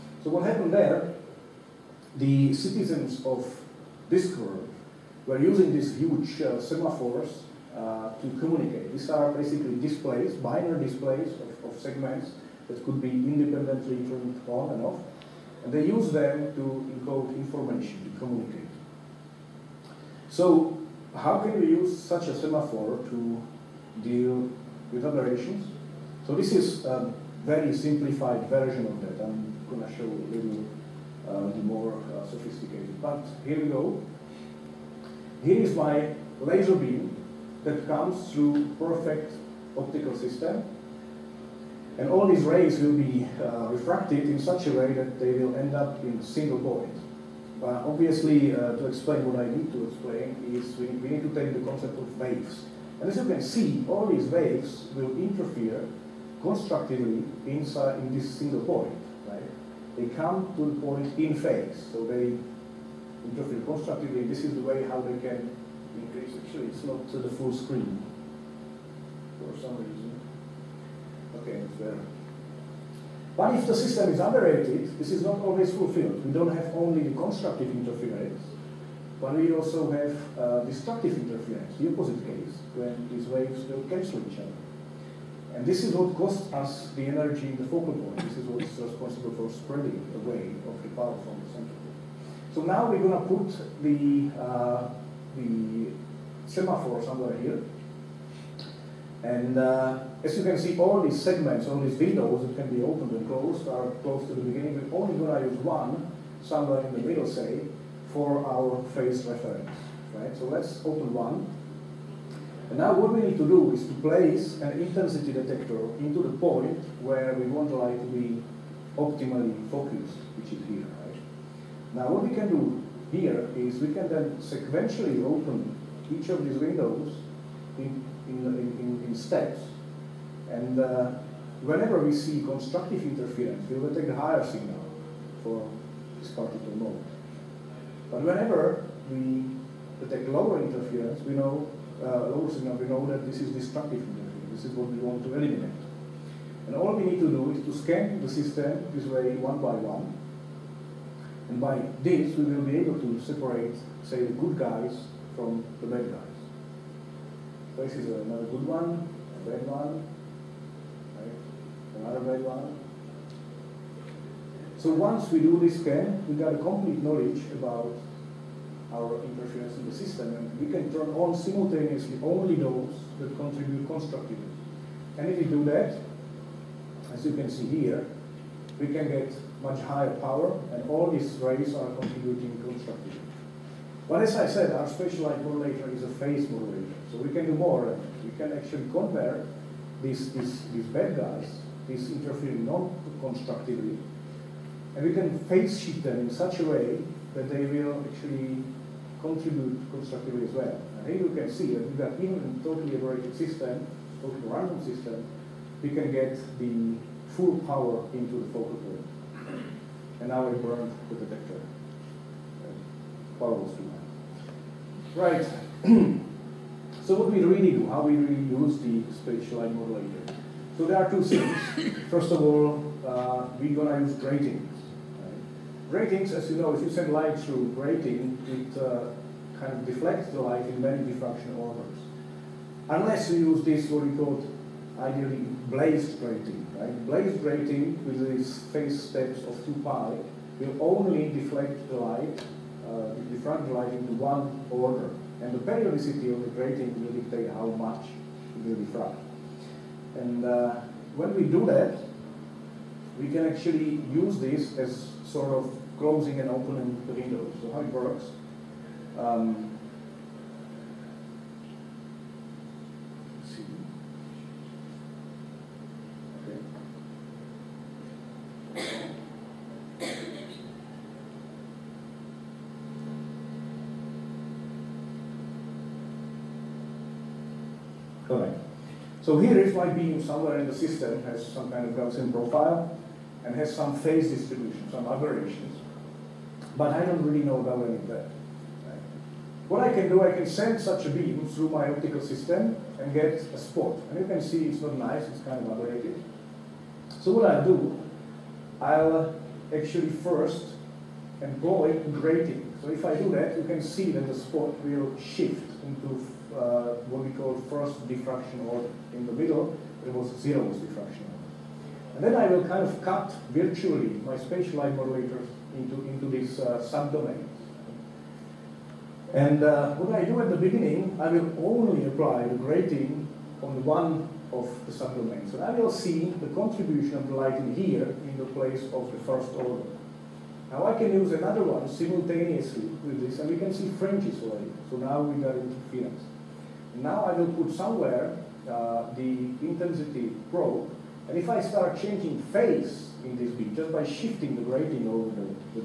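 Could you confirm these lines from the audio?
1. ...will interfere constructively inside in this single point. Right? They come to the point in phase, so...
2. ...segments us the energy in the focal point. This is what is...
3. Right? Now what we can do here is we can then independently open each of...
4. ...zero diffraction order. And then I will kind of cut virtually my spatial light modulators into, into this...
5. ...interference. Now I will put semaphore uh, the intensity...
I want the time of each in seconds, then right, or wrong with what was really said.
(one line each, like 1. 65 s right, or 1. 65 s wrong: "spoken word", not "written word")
1. 54 s right
2. 86 s wrong: "costs", not "segments"
3. 121 s wrong: "sequentially", not "independently"
4. 310 s right
5. 335 s wrong: "somewhere", not "semaphore".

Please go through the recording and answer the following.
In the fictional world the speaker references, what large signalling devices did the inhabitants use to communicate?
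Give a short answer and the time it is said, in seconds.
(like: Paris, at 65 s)
semaphores, at 6 s.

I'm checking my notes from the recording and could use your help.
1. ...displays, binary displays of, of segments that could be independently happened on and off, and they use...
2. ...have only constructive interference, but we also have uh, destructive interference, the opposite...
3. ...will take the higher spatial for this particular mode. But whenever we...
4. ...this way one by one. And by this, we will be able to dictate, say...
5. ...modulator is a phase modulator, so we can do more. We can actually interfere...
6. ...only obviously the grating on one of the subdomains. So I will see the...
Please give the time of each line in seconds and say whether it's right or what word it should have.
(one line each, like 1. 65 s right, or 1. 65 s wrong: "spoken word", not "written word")
1. 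9 s wrong: "turned", not "happened"
2. 76 s right
3. 133 s wrong: "signal", not "spatial"
4. 148 s wrong: "separate", not "dictate"
5. 185 s wrong: "compare", not "interfere"
6. 321 s wrong: "apply", not "obviously".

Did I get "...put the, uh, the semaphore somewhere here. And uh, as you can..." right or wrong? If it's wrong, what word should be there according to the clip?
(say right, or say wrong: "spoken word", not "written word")
right.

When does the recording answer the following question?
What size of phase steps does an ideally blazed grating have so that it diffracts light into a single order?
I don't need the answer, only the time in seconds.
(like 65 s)
239 s.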